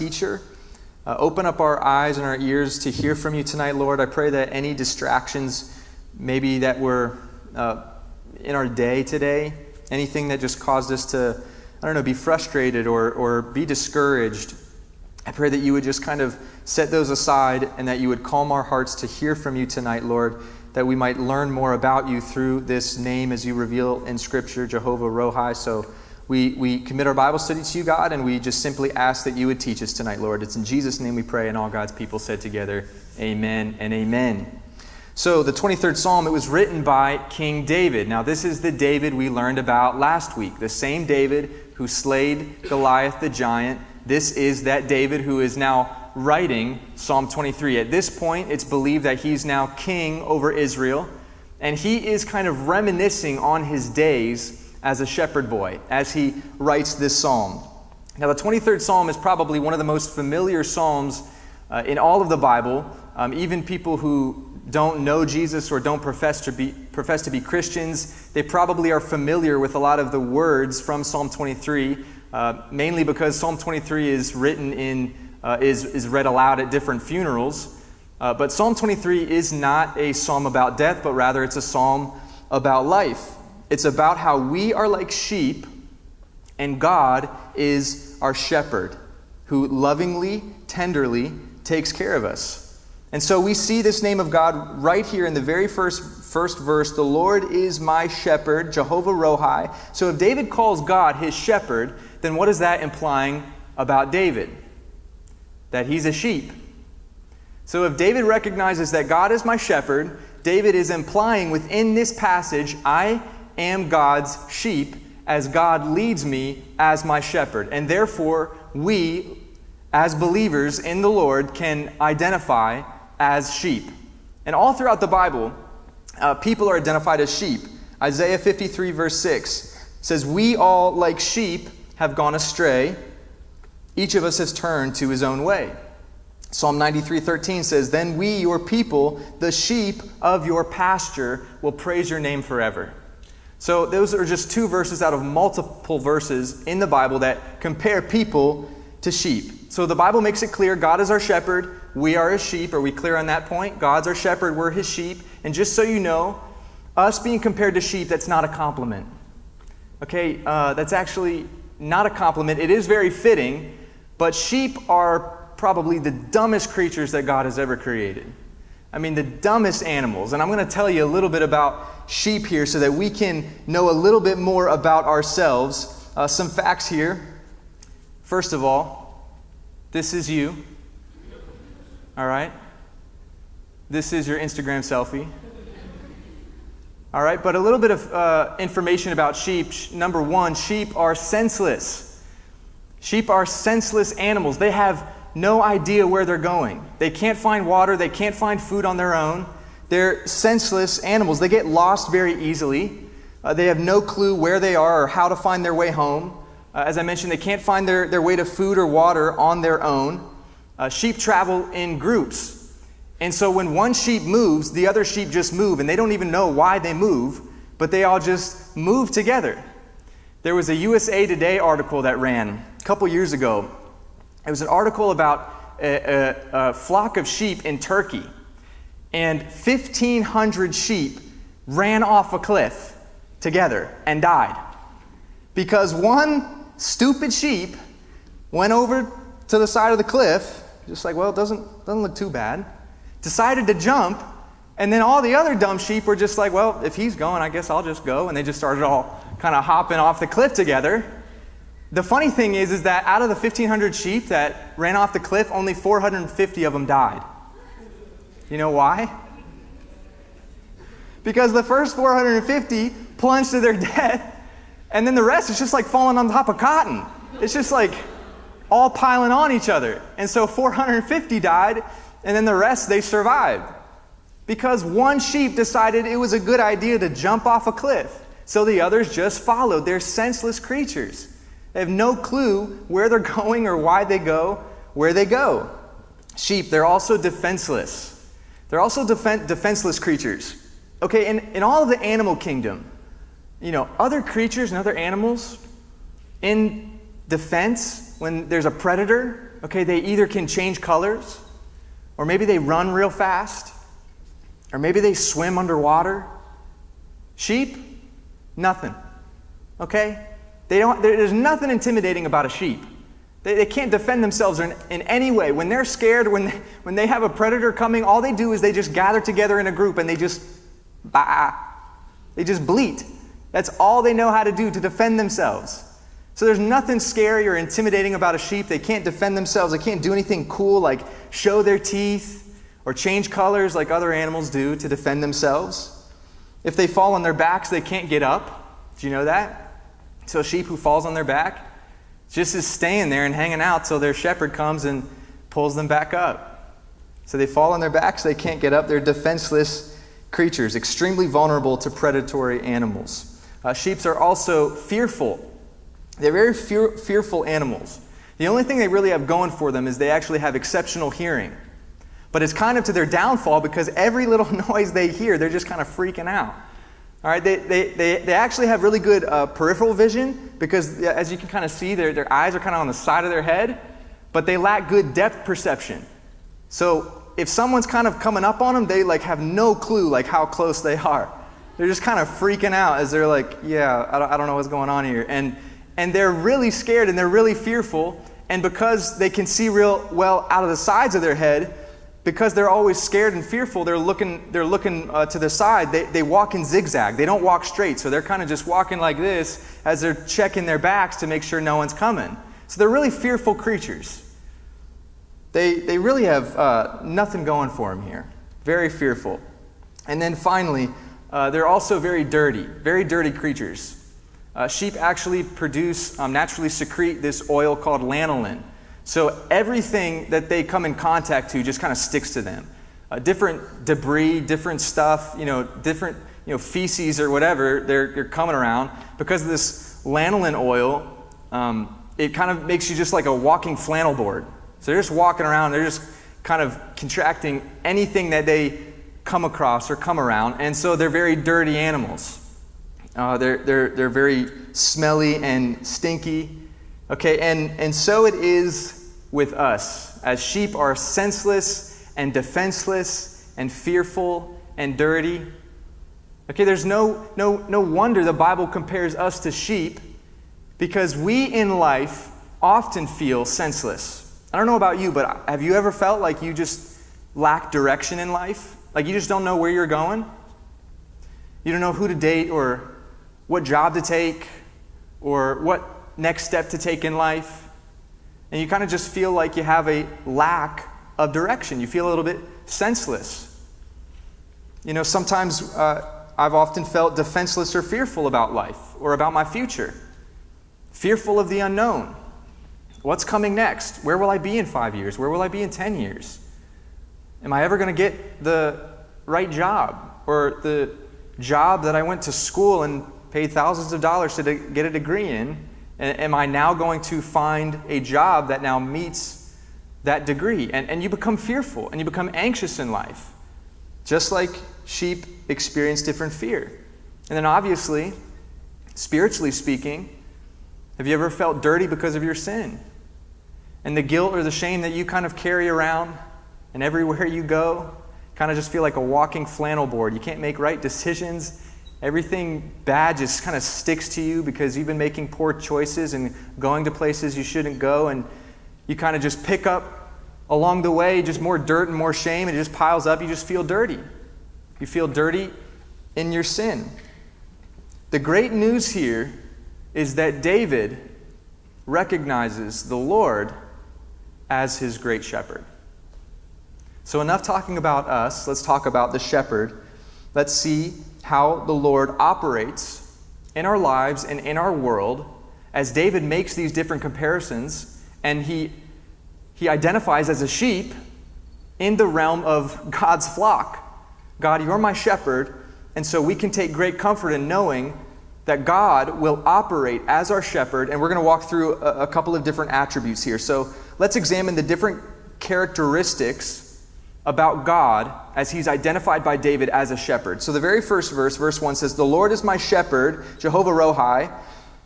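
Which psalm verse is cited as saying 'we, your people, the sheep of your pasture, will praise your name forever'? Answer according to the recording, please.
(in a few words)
Psalm 93:13.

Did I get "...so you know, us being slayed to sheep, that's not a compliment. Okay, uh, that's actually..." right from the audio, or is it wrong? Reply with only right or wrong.
wrong.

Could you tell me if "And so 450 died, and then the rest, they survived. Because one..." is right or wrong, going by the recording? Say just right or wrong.
right.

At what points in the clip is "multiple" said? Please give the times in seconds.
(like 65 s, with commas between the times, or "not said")
145 s.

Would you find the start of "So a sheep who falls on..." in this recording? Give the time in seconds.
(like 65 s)
340 s.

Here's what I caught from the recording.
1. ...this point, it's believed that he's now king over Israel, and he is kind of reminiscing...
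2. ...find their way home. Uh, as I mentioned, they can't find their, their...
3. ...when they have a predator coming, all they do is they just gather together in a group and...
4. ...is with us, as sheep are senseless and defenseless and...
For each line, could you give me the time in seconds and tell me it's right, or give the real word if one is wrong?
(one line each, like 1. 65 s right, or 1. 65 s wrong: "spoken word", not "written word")
1. 47 s right
2. 205 s right
3. 316 s right
4. 448 s right.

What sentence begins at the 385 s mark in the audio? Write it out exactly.
And and they're really scared and they're really fearful.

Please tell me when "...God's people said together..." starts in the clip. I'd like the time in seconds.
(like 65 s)
31 s.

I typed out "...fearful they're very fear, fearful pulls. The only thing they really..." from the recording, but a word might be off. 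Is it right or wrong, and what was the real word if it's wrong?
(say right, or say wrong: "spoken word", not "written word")
wrong: "animals", not "pulls".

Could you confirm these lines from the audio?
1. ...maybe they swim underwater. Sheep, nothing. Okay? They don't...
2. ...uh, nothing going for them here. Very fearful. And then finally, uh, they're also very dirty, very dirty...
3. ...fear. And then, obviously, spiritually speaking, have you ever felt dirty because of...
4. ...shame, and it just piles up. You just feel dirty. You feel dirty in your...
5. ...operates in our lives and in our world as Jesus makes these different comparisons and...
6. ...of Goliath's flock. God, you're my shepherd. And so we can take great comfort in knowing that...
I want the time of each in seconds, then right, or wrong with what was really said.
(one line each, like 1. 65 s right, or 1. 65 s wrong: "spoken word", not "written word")
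1. 304 s right
2. 406 s right
3. 516 s right
4. 542 s right
5. 562 s wrong: "David", not "Jesus"
6. 572 s wrong: "God", not "Goliath".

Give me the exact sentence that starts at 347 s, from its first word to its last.
So they fall on their backs, they can't get up.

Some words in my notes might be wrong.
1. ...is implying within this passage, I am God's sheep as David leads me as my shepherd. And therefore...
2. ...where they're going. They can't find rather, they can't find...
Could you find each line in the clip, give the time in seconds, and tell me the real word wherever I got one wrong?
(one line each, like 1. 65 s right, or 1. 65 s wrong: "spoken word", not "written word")
1. 110 s wrong: "God", not "David"
2. 196 s wrong: "water", not "rather".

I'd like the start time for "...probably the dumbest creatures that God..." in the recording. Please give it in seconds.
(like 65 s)
165 s.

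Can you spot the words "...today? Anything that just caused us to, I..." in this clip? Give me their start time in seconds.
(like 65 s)
9 s.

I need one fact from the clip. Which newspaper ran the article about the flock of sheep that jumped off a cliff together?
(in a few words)
USA Today.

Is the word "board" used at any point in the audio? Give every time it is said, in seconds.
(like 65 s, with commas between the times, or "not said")
434 s, 529 s.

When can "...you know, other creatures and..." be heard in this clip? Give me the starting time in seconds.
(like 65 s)
293 s.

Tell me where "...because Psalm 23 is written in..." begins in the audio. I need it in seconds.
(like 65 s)
73 s.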